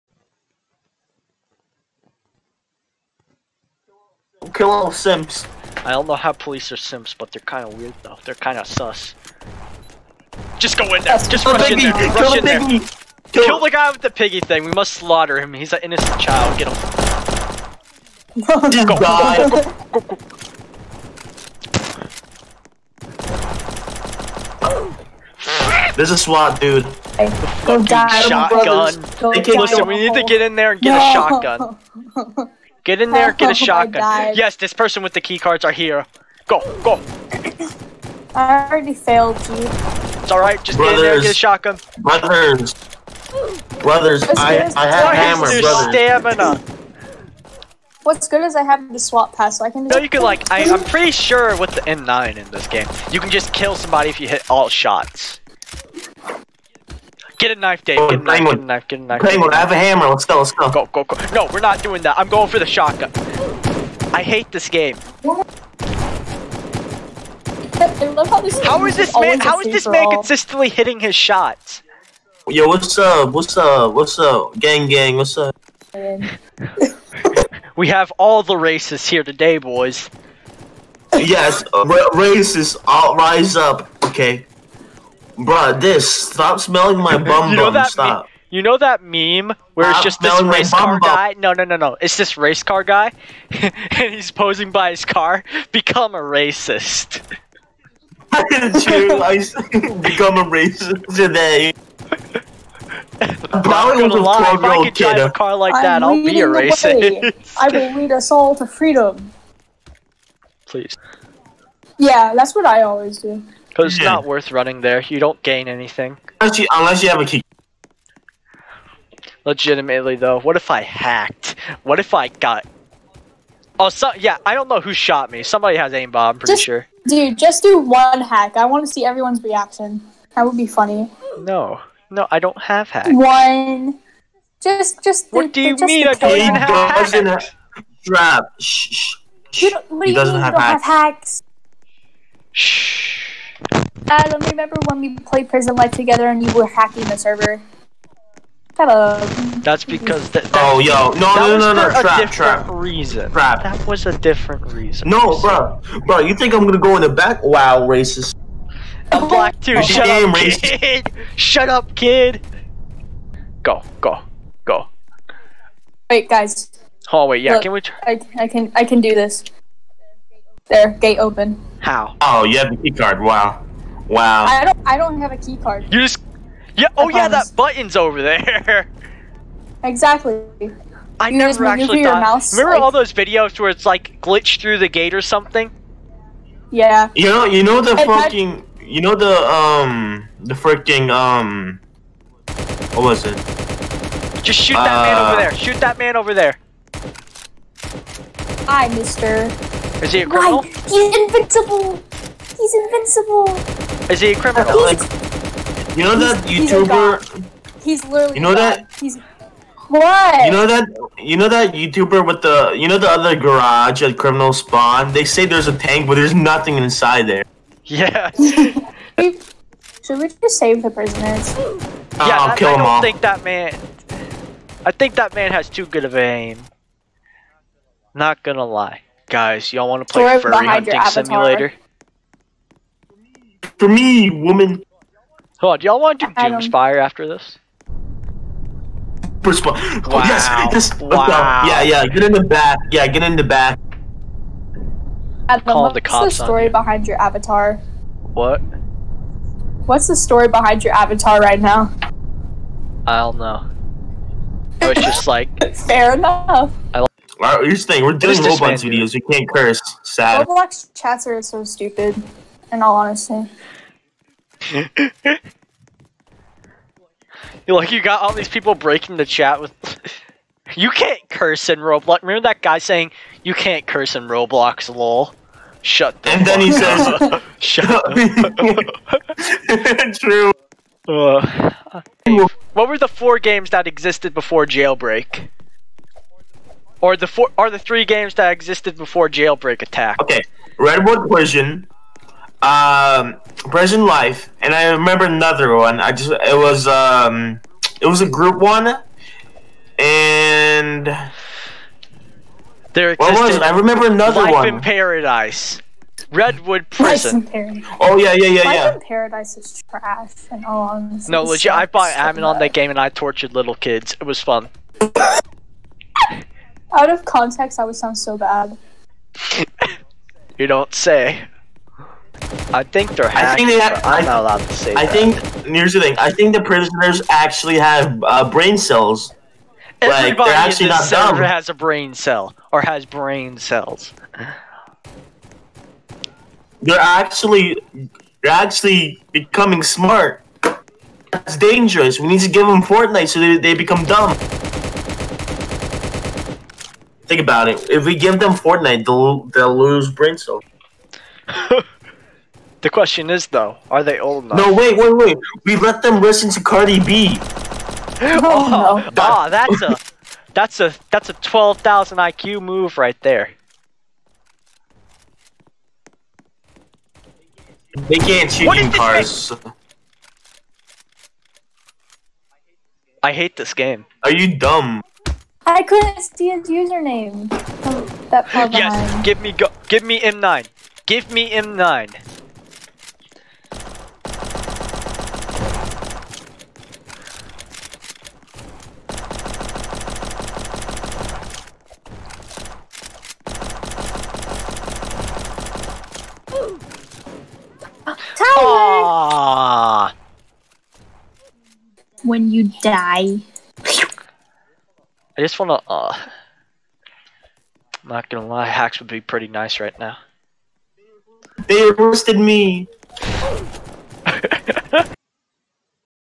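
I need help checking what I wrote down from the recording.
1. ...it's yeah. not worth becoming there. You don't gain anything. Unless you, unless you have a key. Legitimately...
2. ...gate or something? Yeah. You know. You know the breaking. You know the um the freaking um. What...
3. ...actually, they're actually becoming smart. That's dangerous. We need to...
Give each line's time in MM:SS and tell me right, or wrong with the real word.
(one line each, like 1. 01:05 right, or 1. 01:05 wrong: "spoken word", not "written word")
1. 01:53 wrong: "running", not "becoming"
2. 03:04 wrong: "fucking", not "breaking"
3. 05:36 right.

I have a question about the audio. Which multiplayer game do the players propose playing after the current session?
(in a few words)
Doomspire.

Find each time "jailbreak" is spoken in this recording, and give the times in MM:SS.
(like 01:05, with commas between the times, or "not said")
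04:44, 04:49.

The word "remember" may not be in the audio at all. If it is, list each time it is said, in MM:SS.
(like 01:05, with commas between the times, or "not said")
02:24, 03:02, 04:32, 04:54, 05:03.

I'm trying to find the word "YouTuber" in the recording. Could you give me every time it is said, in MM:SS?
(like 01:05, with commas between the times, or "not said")
03:26, 03:31.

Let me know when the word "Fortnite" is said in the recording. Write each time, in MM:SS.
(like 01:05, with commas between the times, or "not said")
05:42, 05:48.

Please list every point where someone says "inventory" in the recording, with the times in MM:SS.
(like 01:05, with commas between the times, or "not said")
not said.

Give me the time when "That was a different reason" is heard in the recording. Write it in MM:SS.
02:33.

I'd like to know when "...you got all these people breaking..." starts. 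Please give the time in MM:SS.
04:27.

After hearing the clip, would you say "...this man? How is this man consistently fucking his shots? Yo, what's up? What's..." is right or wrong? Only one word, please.
wrong.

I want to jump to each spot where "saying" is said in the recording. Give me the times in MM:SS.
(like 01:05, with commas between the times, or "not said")
04:17, 04:32.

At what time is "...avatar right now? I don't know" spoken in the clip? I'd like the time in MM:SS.
04:10.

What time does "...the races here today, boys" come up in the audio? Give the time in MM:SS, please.
01:18.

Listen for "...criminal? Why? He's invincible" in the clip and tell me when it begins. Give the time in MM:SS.
03:20.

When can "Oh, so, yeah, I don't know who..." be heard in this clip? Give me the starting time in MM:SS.
02:03.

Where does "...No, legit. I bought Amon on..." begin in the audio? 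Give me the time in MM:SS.
05:11.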